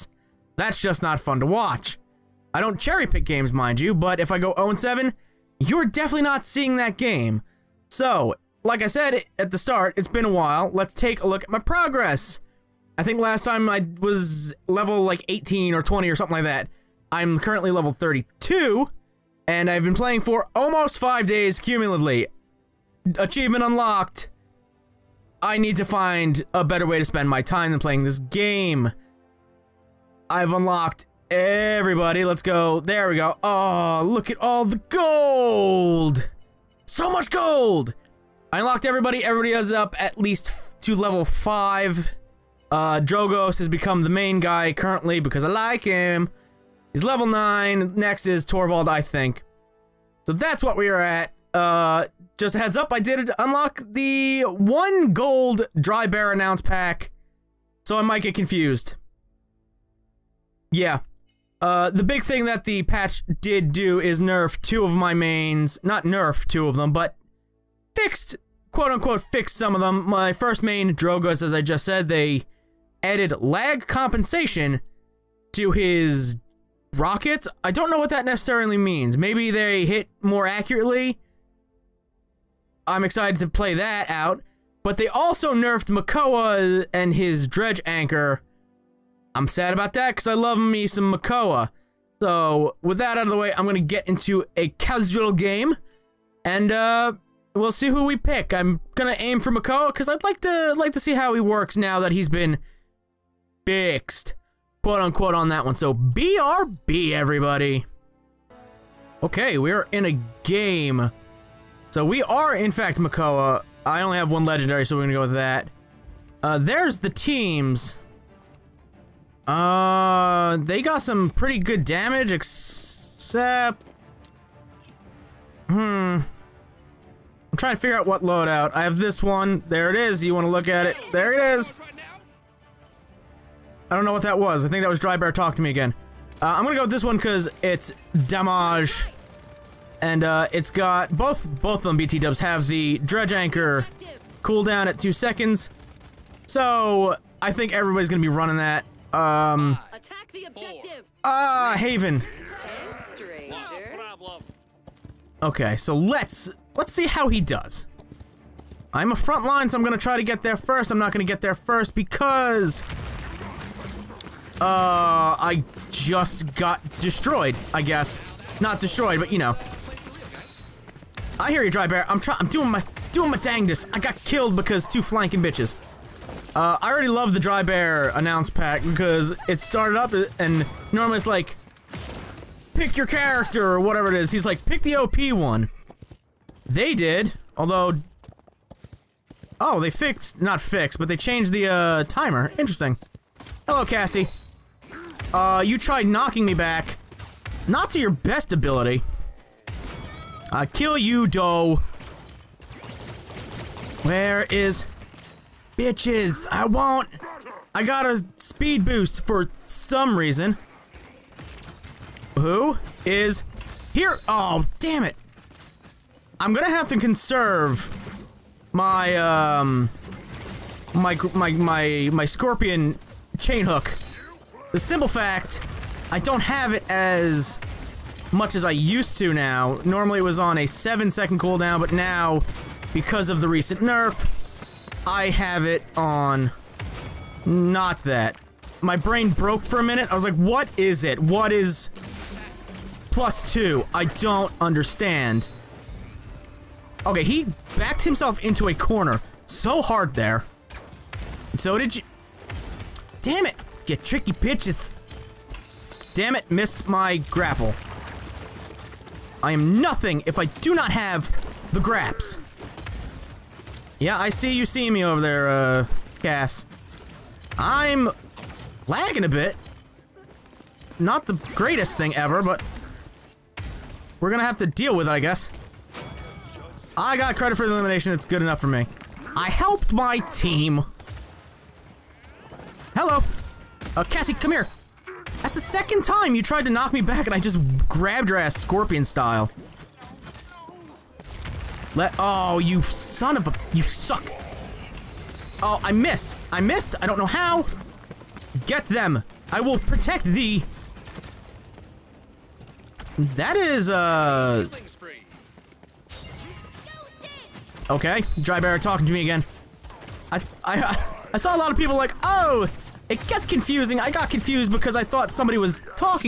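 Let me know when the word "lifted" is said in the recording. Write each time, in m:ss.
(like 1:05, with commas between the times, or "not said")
not said.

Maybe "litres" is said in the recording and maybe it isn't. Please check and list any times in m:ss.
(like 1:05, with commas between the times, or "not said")
not said.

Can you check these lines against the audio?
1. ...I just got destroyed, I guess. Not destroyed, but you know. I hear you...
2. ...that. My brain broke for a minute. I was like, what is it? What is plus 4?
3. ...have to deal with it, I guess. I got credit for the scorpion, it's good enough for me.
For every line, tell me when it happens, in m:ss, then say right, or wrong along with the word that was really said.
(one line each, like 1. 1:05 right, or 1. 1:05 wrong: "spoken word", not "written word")
1. 2:45 right
2. 3:58 wrong: "2", not "4"
3. 4:34 wrong: "elimination", not "scorpion".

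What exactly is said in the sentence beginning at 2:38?
I'm a front line, so I'm gonna try to get there first.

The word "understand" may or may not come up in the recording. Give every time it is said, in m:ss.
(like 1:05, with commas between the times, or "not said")
4:04.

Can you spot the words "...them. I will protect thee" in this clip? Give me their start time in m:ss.
4:58.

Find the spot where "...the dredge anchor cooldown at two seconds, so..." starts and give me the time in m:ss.
2:22.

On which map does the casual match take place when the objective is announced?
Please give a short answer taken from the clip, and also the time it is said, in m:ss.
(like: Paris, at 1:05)
Haven, at 2:31.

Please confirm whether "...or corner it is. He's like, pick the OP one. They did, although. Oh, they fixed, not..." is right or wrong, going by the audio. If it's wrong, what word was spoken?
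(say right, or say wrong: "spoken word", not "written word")
wrong: "whatever", not "corner".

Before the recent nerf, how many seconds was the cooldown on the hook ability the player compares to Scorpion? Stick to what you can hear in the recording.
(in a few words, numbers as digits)
7.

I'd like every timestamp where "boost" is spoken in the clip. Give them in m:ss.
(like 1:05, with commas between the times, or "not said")
3:28.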